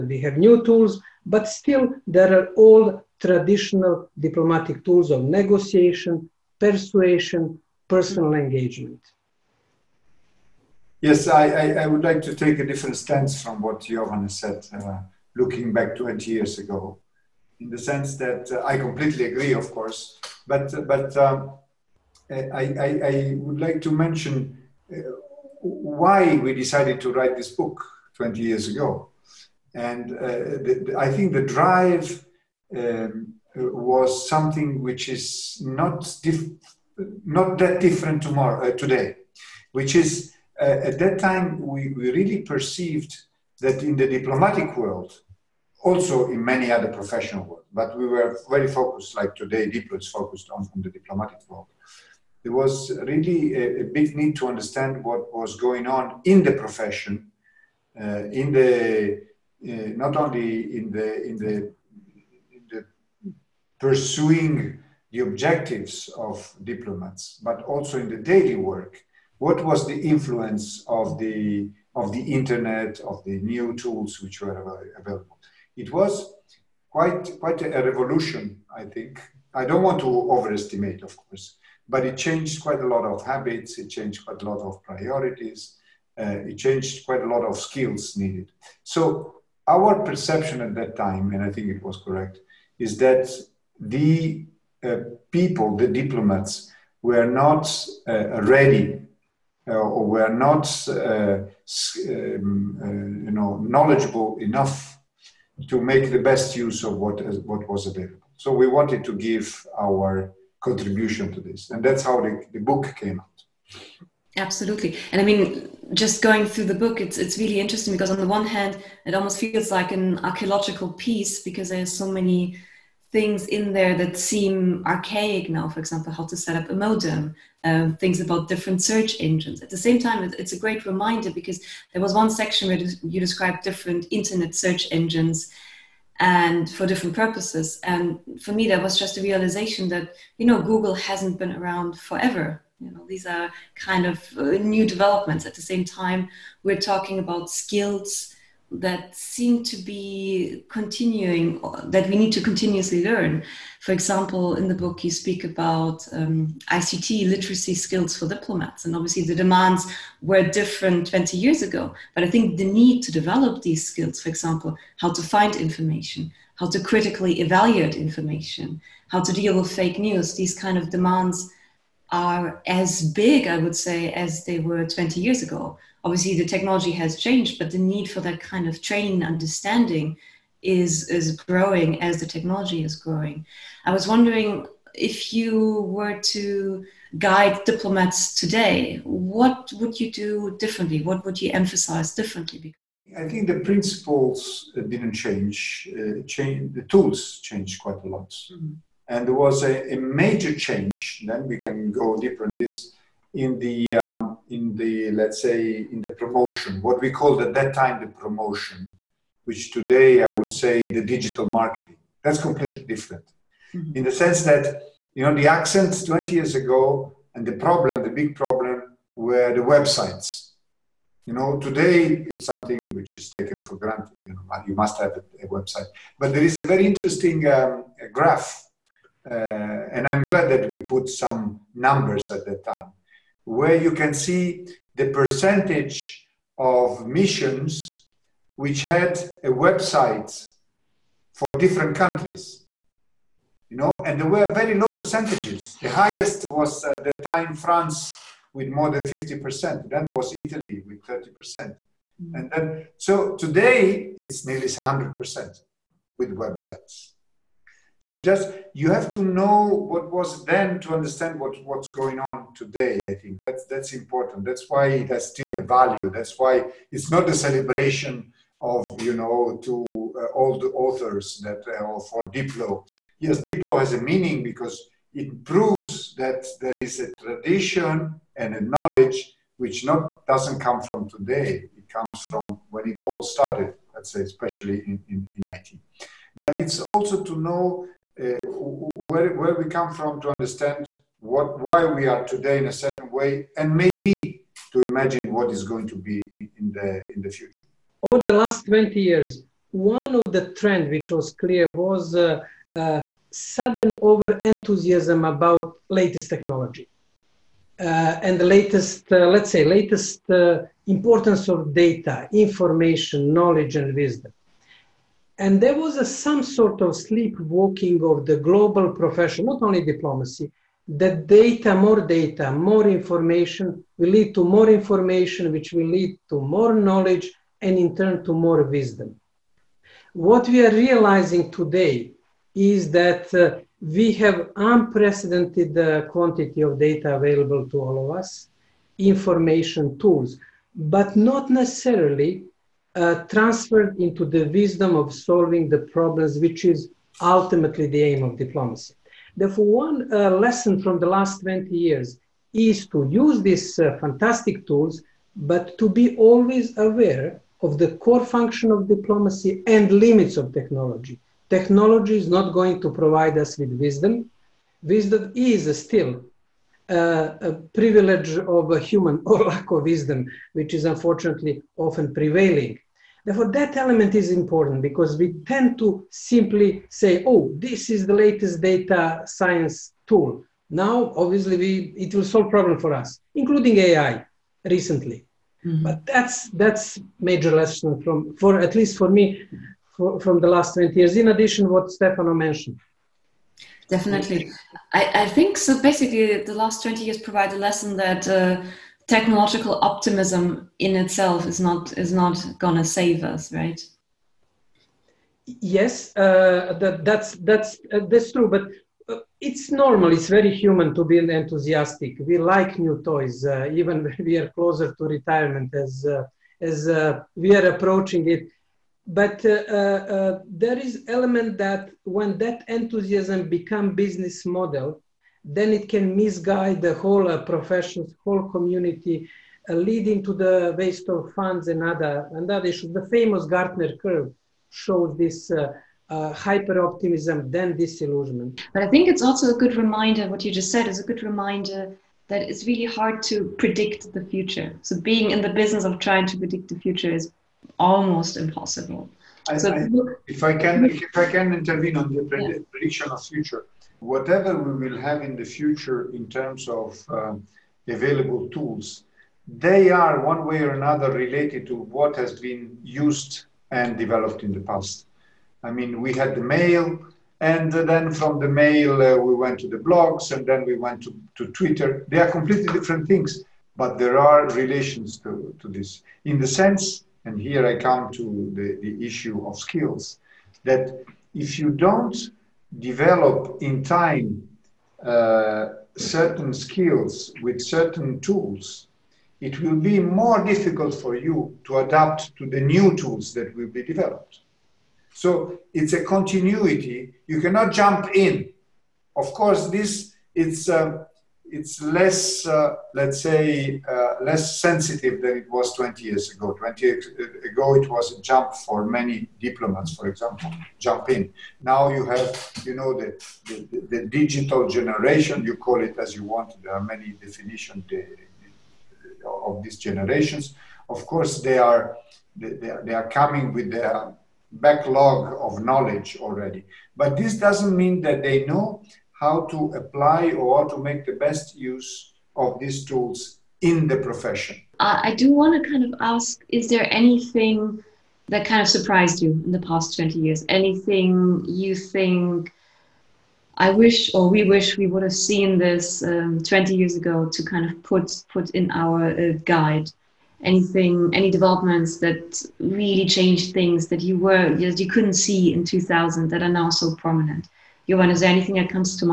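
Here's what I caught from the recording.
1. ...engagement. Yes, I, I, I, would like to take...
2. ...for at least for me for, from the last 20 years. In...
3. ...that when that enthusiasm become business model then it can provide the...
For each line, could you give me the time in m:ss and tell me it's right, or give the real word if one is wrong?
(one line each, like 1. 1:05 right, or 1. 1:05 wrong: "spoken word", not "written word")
1. 0:08 right
2. 6:28 right
3. 7:01 wrong: "misguide", not "provide".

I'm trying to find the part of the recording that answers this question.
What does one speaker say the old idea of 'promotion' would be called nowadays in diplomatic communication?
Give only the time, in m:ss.
3:31.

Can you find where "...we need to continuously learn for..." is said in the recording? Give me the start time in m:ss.
2:32.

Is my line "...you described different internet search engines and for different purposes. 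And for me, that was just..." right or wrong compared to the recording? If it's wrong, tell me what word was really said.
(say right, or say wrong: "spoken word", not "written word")
right.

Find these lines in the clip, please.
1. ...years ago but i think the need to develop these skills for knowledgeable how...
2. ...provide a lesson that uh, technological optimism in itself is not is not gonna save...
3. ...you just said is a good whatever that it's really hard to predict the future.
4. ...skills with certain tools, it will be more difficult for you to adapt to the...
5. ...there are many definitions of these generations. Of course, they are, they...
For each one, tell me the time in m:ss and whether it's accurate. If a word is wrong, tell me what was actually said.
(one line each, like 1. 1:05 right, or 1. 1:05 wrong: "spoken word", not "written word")
1. 2:41 wrong: "example", not "knowledgeable"
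2. 6:37 right
3. 7:20 wrong: "reminder", not "whatever"
4. 8:06 right
5. 8:36 right.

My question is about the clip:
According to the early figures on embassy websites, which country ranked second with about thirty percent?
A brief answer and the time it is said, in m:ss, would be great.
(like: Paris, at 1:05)
Italy, at 4:10.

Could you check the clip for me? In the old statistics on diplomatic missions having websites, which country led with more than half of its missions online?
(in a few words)
France.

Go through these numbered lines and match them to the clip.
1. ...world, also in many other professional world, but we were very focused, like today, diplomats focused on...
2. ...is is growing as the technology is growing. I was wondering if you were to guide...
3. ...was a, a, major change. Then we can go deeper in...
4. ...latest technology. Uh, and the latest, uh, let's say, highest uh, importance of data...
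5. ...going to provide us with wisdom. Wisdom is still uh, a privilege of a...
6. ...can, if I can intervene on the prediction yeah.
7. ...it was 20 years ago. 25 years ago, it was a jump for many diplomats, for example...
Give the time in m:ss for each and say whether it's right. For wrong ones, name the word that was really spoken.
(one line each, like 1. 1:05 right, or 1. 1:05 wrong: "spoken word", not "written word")
1. 0:44 right
2. 3:00 right
3. 3:19 right
4. 5:05 wrong: "latest", not "highest"
5. 6:02 right
6. 7:30 right
7. 8:25 wrong: "20", not "25".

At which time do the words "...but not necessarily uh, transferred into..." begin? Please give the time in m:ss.
5:40.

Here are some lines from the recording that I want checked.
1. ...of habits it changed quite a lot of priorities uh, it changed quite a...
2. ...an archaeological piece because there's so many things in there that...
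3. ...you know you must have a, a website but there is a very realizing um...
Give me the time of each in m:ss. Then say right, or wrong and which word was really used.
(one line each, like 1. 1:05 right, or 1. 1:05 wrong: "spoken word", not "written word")
1. 1:23 right
2. 1:59 right
3. 3:44 wrong: "interesting", not "realizing".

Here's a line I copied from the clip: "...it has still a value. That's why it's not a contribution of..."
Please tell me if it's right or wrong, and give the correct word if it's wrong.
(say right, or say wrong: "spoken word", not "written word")
wrong: "celebration", not "contribution".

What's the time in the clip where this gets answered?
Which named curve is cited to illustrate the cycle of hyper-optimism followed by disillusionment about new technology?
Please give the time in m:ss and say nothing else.
7:13.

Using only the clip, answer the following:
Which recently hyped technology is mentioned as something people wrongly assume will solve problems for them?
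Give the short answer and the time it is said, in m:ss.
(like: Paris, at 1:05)
AI, at 6:23.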